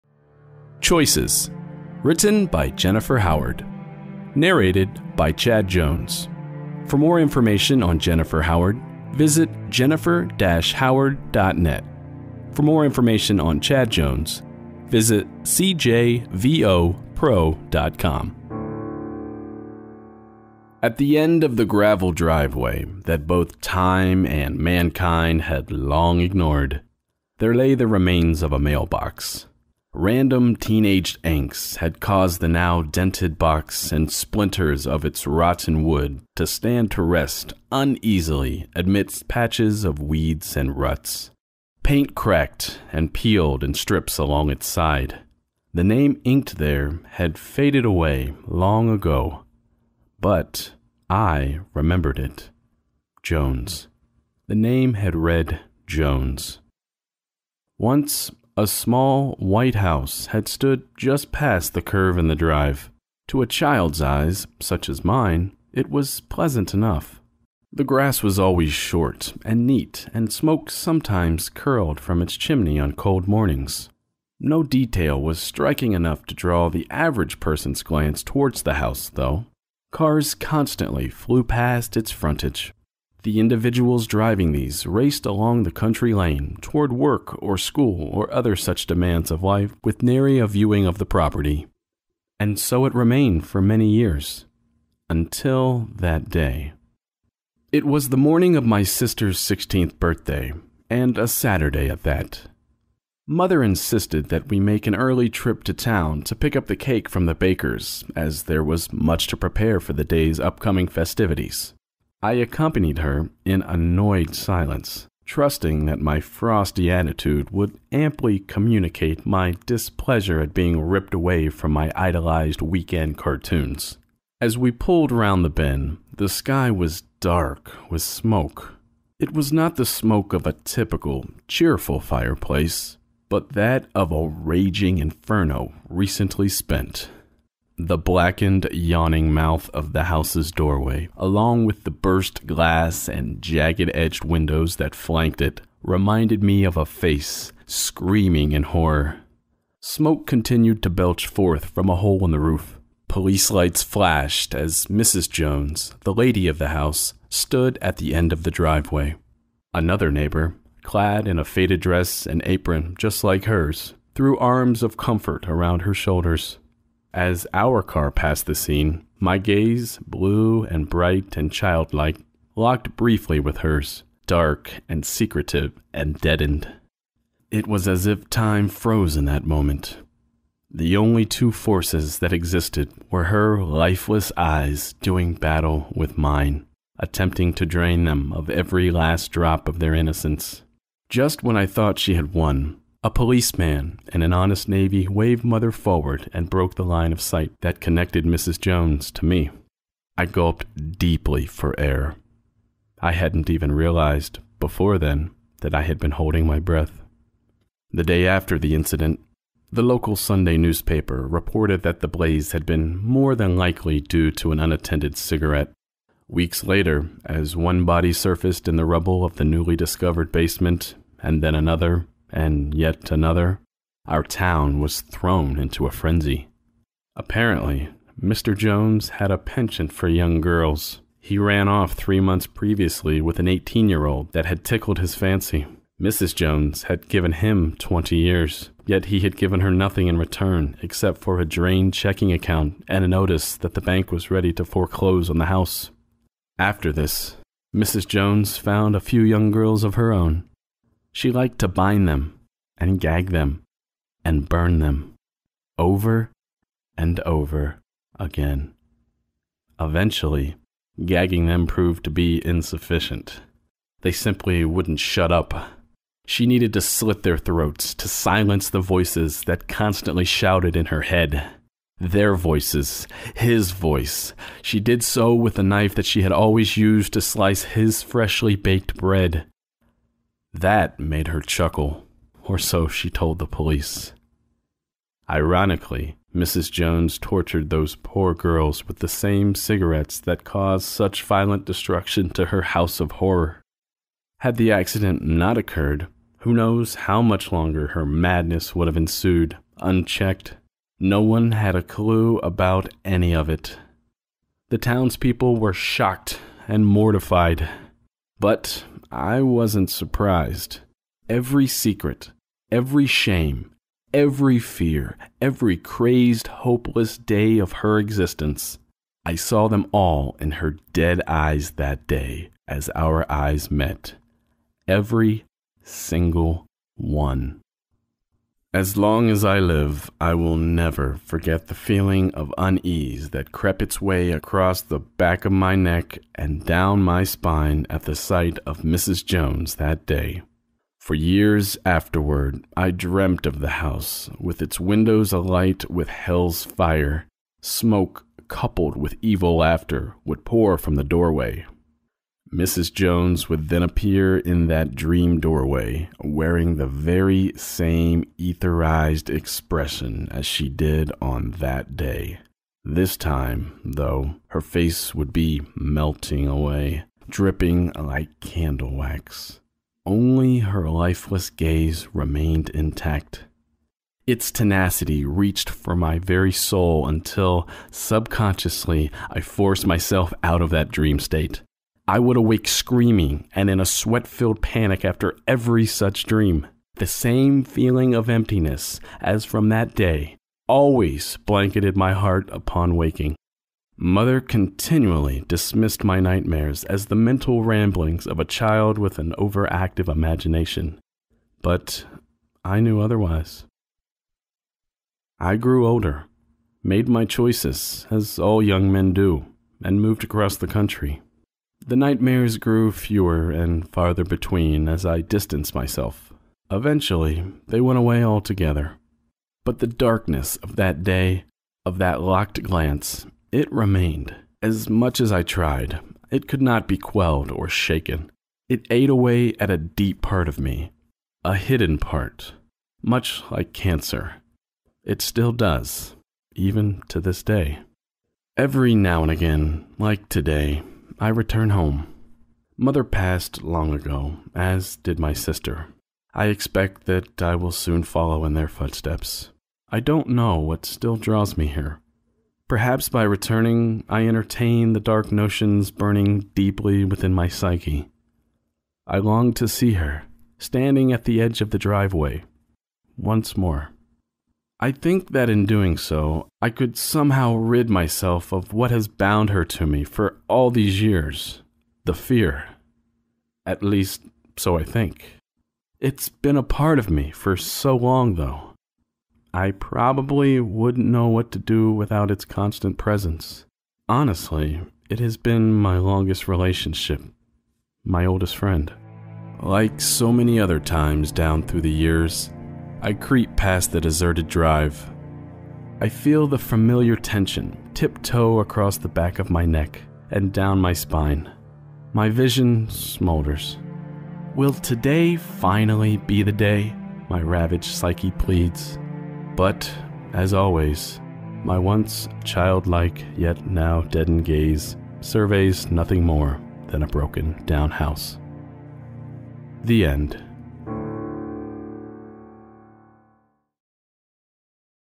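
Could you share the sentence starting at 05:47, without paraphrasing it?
Smoke, coupled with evil laughter, would pour from the doorway.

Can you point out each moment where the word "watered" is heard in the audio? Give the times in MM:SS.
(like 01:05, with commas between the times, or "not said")
not said.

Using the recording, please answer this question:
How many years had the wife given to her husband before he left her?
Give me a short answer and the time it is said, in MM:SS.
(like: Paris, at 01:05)
20 years, at 03:57.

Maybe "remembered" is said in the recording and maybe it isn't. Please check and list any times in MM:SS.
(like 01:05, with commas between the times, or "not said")
00:51.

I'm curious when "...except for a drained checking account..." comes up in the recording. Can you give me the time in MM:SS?
04:00.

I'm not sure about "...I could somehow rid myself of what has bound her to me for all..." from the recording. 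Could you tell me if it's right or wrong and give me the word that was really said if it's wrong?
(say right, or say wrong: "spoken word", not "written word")
right.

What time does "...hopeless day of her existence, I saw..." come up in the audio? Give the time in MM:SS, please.
05:16.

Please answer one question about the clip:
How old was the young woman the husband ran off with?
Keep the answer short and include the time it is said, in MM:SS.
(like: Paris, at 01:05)
18, at 03:53.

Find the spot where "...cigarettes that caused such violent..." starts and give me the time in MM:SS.
04:49.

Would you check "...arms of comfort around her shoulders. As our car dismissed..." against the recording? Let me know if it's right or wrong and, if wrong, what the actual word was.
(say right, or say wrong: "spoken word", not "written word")
wrong: "passed", not "dismissed".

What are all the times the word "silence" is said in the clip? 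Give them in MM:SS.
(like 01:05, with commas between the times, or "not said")
01:54, 04:28.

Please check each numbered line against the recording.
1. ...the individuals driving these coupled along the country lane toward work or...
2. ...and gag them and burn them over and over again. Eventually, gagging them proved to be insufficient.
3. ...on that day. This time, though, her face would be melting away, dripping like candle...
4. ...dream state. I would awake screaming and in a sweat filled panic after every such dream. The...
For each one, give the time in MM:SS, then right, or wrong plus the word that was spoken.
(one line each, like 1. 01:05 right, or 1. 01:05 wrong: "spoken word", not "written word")
1. 01:23 wrong: "raced", not "coupled"
2. 04:12 right
3. 06:01 right
4. 06:20 right.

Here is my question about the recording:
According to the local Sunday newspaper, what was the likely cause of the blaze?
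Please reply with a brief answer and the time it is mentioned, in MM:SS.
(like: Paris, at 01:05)
Unattended cigarette, at 03:34.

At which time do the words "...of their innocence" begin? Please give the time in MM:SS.
03:09.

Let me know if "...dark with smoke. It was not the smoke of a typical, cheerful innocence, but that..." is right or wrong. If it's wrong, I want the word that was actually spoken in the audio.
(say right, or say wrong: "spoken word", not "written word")
wrong: "fireplace", not "innocence".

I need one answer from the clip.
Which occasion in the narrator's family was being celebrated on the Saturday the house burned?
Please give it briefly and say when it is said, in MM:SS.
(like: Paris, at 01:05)
Sister's 16th birthday, at 01:38.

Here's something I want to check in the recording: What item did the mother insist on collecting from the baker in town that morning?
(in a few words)
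The cake.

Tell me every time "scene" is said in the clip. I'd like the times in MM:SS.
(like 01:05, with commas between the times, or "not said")
02:48.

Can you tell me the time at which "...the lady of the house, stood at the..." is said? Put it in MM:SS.
02:36.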